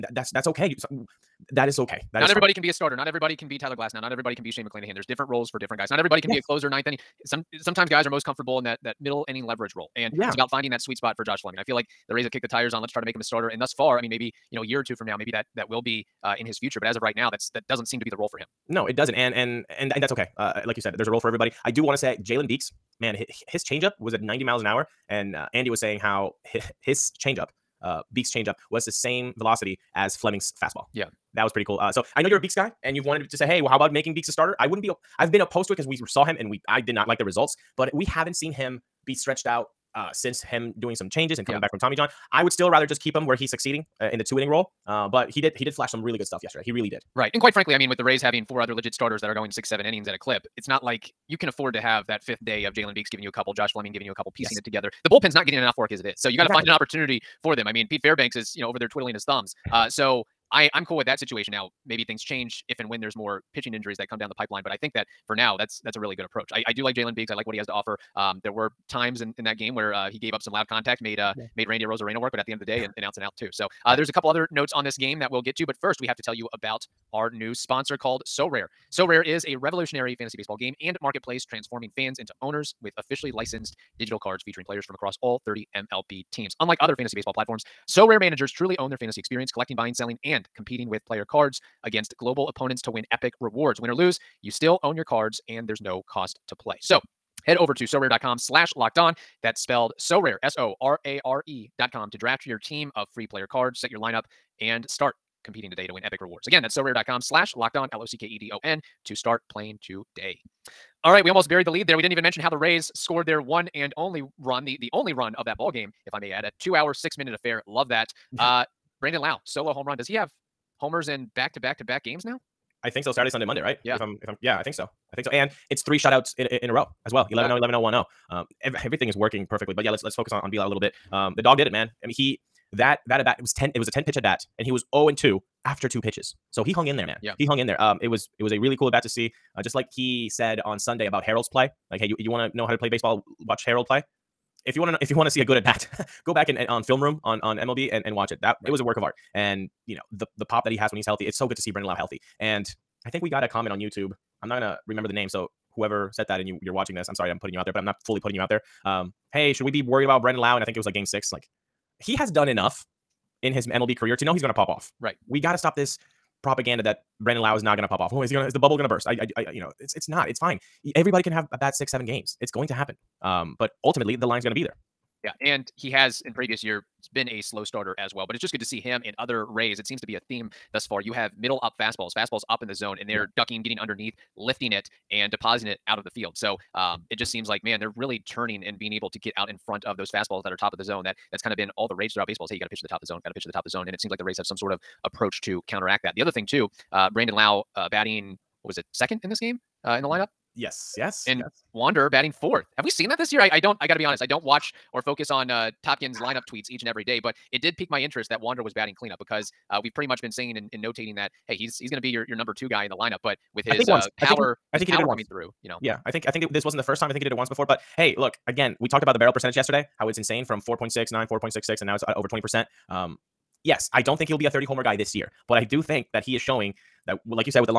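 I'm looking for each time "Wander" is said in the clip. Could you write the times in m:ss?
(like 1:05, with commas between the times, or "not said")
3:21, 3:28.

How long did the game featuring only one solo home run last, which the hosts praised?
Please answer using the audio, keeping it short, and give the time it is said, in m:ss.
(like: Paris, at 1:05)
2 hours, 6 minutes, at 1:56.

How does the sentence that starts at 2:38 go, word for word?
Um, hey, should we be worried about Brandon Lowe?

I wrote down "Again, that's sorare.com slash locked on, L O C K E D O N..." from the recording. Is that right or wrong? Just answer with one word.
right.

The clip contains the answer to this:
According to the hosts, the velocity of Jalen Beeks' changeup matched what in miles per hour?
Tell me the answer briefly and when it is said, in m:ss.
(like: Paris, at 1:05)
90, at 0:24.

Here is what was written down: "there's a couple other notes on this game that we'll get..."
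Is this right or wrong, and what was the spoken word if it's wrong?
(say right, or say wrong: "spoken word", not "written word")
right.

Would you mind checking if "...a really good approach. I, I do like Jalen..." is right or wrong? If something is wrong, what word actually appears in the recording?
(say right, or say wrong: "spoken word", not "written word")
right.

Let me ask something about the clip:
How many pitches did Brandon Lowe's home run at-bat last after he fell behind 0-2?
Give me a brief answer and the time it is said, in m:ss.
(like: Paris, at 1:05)
10, at 2:13.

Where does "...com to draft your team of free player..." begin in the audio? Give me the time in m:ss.
1:41.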